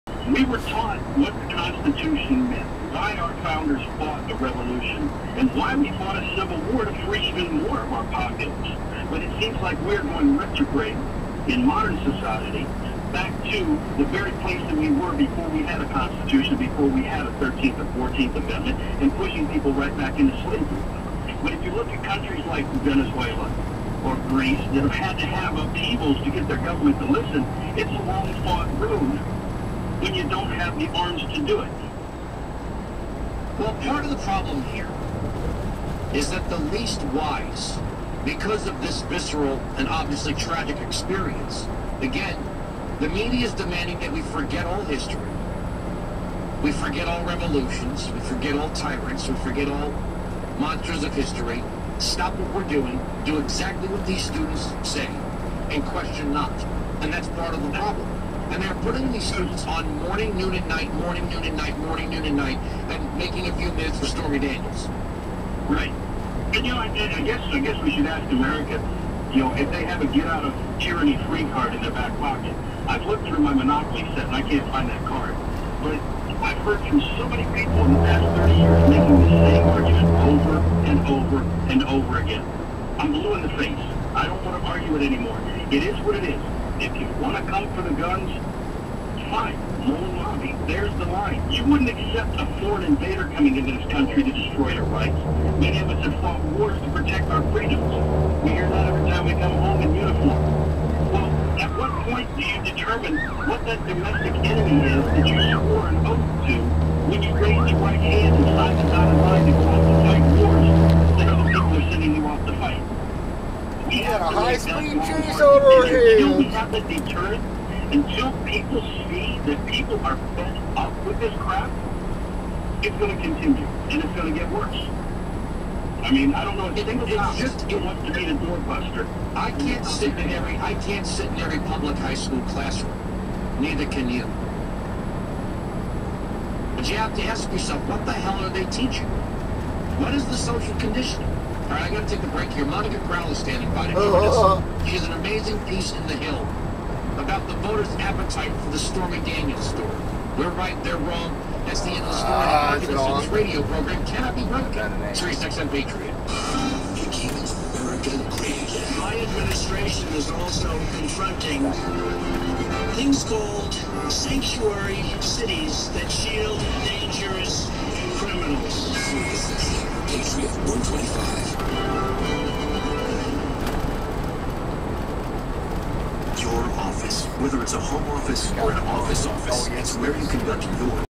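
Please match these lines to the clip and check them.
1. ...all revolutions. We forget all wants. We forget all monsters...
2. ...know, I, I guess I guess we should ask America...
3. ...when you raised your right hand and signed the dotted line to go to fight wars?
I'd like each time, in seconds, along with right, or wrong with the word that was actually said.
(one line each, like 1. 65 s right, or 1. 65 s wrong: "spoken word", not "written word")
1. 47 s wrong: "tyrants", not "wants"
2. 66 s right
3. 107 s right.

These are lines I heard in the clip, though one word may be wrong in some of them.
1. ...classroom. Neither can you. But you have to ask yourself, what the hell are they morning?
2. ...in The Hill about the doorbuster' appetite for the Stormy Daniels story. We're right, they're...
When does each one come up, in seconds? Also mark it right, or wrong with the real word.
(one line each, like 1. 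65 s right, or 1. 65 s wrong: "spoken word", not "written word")
1. 132 s wrong: "teaching", not "morning"
2. 145 s wrong: "voters", not "doorbuster".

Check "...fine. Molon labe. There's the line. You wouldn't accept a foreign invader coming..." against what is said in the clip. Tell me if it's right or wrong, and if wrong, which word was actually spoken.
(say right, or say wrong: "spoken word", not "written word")
right.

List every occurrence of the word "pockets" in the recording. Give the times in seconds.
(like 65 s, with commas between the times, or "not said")
8 s, 72 s.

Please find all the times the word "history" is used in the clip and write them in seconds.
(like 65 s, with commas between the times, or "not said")
44 s, 51 s.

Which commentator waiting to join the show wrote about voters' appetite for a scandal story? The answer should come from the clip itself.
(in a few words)
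Monica Crowley.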